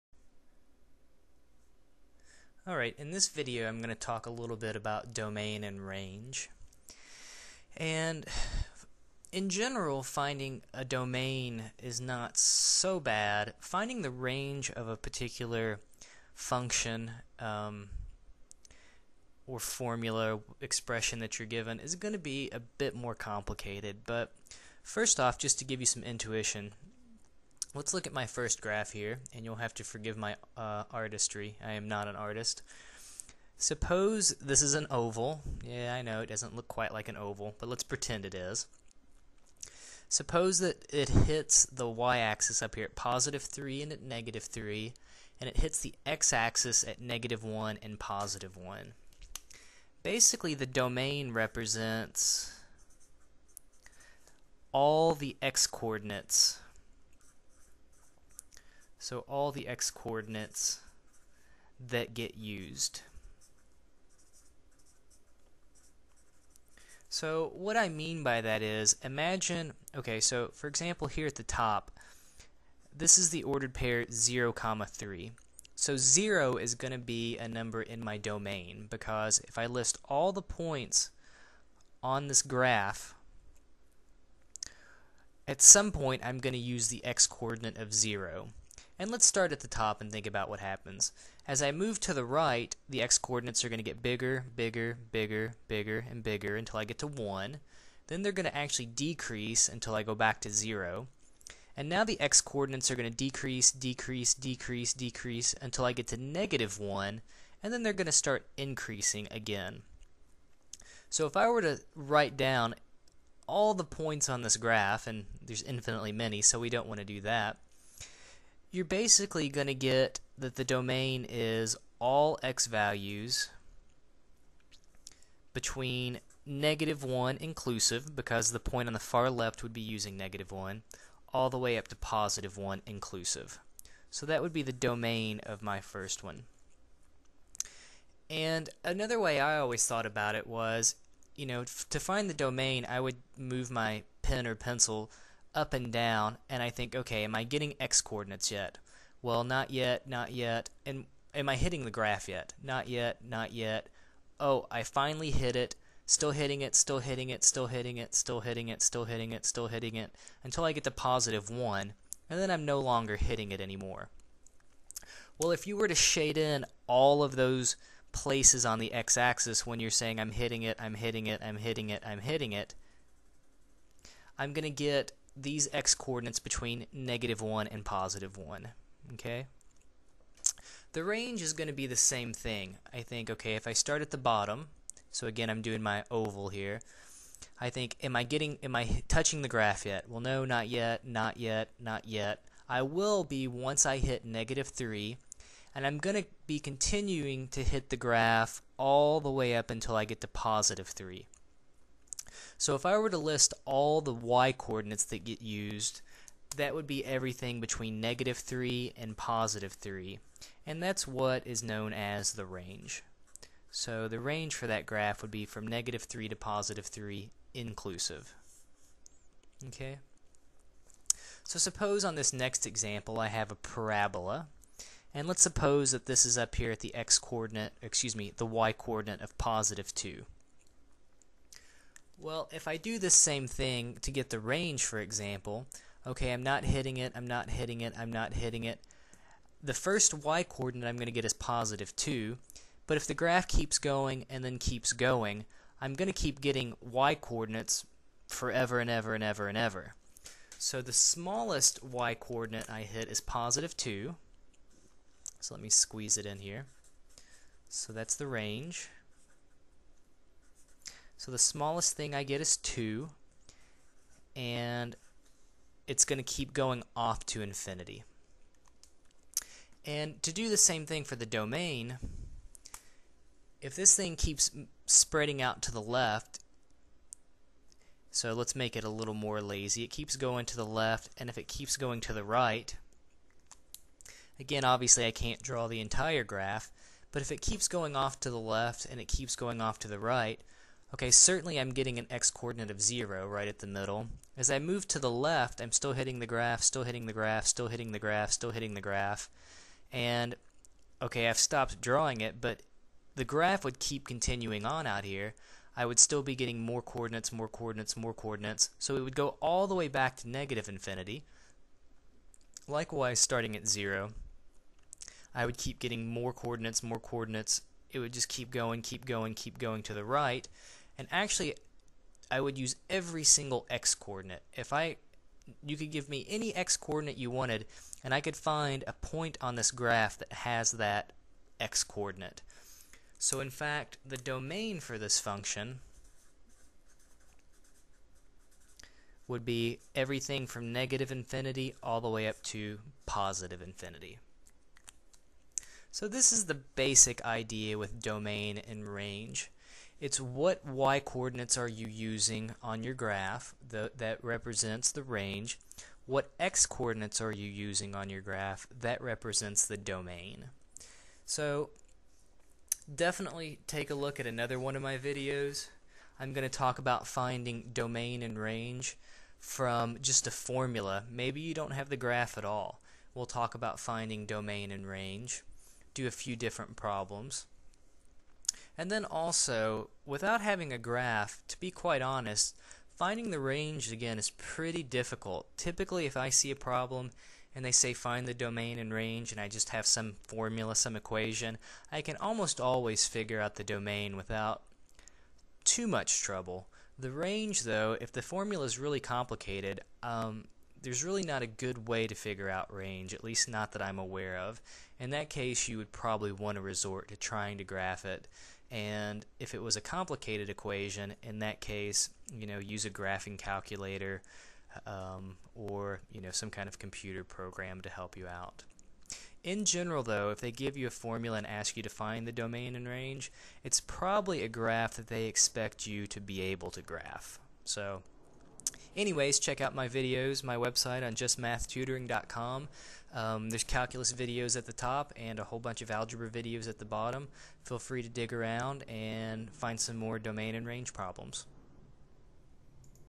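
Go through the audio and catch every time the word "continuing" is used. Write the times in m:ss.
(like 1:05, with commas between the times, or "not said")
3:16, 5:04.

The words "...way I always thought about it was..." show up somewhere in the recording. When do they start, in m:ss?
2:19.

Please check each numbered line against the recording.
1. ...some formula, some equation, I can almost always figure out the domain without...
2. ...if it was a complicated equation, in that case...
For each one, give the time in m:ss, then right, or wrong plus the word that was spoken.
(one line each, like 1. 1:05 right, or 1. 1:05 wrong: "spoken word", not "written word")
1. 6:29 right
2. 6:49 right.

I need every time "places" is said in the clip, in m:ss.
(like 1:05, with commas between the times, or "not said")
2:48.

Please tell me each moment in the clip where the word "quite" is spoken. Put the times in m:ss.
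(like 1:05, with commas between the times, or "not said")
0:36, 6:21.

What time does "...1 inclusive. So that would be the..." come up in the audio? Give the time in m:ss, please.
2:12.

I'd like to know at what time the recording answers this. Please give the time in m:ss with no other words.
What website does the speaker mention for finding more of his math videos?
7:11.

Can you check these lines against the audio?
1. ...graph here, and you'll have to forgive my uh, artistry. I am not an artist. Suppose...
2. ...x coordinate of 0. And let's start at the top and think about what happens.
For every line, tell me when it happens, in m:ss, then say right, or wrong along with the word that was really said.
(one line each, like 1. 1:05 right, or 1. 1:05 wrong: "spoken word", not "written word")
1. 0:28 right
2. 1:27 right.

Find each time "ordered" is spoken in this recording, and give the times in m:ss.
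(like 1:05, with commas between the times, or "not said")
1:13.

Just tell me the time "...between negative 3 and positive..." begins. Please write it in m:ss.
3:27.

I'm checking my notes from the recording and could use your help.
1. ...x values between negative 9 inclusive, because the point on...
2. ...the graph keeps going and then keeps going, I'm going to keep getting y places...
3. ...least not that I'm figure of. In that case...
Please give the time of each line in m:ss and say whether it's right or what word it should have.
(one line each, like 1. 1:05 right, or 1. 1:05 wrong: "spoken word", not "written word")
1. 2:02 wrong: "1", not "9"
2. 4:03 wrong: "coordinates", not "places"
3. 6:43 wrong: "aware", not "figure".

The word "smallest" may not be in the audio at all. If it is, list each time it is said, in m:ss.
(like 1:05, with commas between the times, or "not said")
4:10, 4:21.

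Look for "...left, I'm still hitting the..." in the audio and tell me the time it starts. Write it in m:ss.
4:55.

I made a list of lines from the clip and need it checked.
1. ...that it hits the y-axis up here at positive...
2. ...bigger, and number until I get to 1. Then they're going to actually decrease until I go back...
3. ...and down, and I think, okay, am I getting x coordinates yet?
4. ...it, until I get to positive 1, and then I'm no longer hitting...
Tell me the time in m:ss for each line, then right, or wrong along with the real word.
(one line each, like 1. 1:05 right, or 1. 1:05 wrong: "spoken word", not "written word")
1. 0:40 right
2. 1:35 wrong: "bigger", not "number"
3. 2:25 right
4. 2:39 right.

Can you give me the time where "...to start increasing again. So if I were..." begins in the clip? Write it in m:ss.
1:48.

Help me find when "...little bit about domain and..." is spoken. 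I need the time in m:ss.
0:04.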